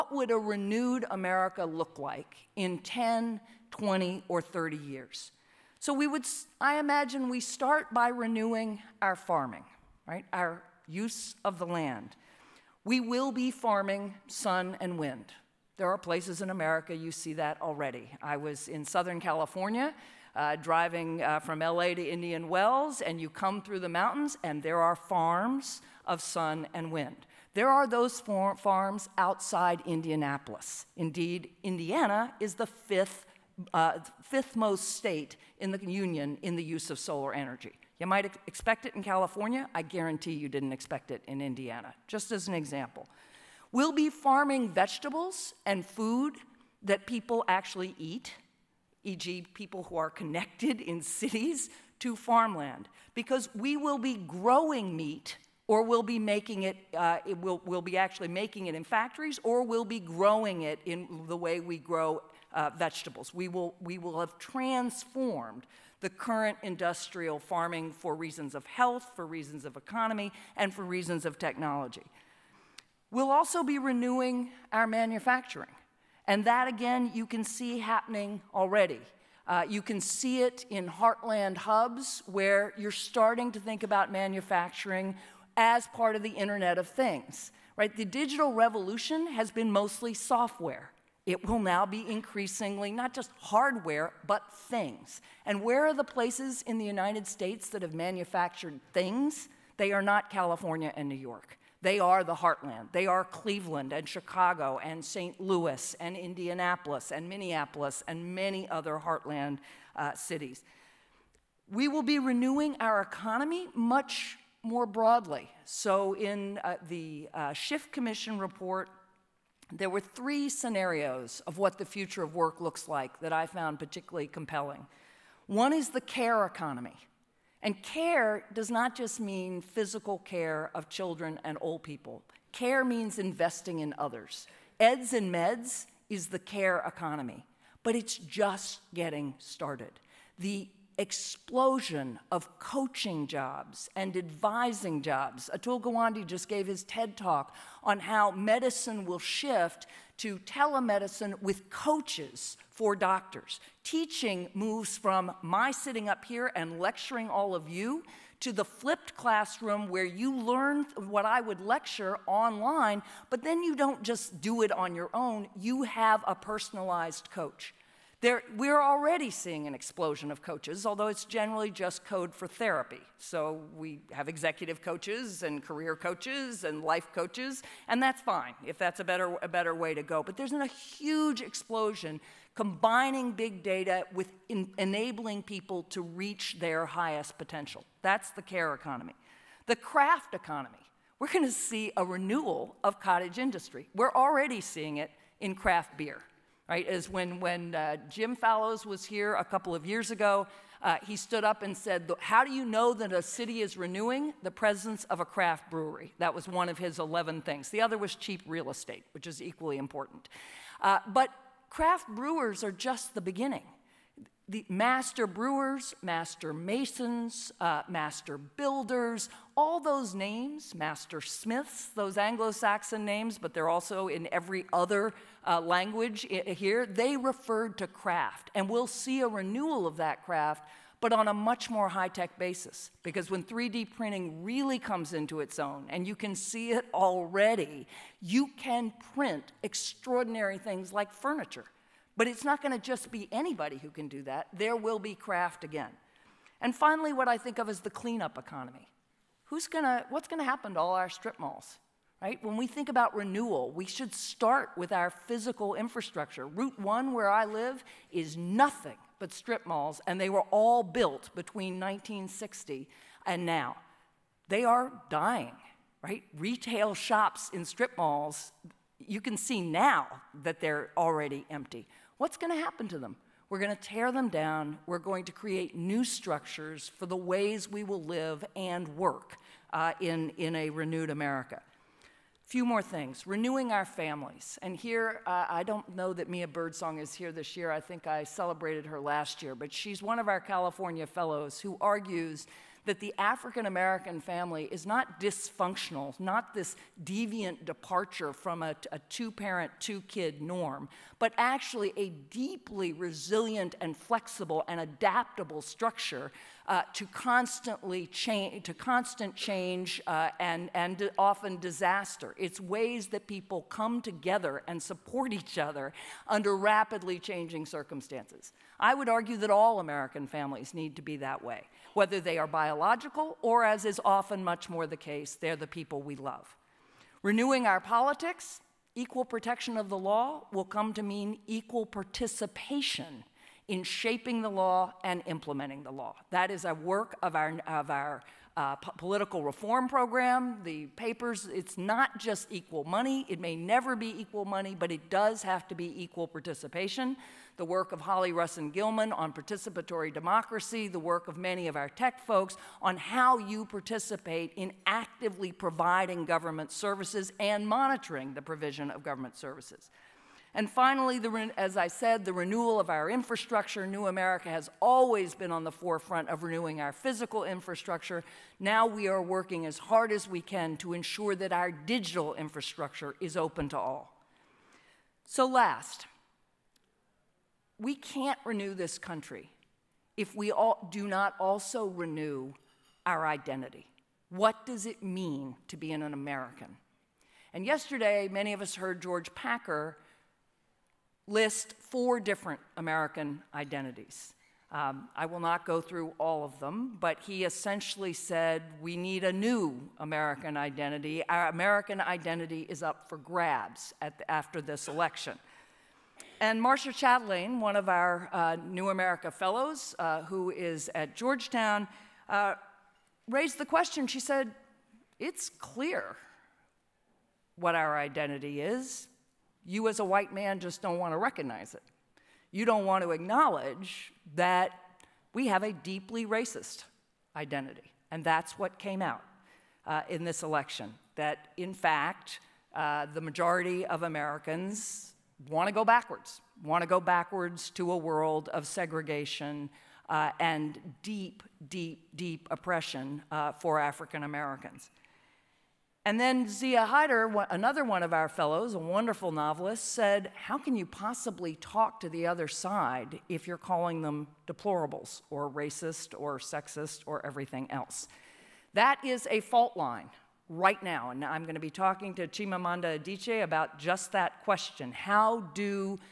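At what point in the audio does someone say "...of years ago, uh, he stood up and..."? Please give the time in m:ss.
3:19.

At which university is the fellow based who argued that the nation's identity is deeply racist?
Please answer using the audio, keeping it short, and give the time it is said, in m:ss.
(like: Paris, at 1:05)
Georgetown, at 6:51.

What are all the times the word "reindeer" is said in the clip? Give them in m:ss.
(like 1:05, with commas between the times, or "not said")
not said.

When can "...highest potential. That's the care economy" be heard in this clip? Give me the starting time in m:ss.
3:06.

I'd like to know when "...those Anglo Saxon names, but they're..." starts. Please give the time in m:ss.
3:41.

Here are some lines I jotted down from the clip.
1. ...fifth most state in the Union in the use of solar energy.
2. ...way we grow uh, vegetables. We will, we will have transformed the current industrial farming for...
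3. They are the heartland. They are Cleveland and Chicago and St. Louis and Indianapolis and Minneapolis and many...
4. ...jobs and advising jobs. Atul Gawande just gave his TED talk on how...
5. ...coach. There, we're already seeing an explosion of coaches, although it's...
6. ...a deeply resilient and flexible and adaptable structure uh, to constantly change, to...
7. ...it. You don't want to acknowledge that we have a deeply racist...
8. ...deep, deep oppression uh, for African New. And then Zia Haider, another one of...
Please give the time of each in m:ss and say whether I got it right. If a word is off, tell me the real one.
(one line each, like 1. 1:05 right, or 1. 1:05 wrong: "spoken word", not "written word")
1. 0:34 right
2. 1:01 right
3. 1:41 right
4. 2:23 right
5. 2:47 right
6. 5:01 right
7. 7:01 right
8. 7:21 wrong: "Americans", not "New".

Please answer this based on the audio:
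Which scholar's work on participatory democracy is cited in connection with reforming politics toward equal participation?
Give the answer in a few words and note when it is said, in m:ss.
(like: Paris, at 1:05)
Hollie Russon Gilman, at 5:48.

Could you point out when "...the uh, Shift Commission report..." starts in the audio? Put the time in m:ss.
1:56.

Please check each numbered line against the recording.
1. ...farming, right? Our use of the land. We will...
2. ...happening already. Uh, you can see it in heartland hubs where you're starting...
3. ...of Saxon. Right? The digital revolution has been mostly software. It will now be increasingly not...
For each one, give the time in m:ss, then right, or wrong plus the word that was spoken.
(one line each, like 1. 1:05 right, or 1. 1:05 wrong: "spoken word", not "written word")
1. 0:09 right
2. 1:17 right
3. 1:26 wrong: "Things", not "Saxon".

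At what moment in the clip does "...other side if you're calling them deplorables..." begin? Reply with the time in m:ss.
7:32.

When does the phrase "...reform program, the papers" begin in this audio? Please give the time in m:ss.
5:39.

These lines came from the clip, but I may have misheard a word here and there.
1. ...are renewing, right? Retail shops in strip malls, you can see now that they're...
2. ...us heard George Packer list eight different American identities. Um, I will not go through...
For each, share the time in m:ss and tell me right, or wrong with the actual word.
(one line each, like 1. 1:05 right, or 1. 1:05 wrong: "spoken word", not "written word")
1. 4:24 wrong: "dying", not "renewing"
2. 6:28 wrong: "four", not "eight".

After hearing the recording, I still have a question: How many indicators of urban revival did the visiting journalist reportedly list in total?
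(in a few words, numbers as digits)
11.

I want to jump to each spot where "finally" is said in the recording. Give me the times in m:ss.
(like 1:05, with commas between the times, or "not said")
4:06, 6:00.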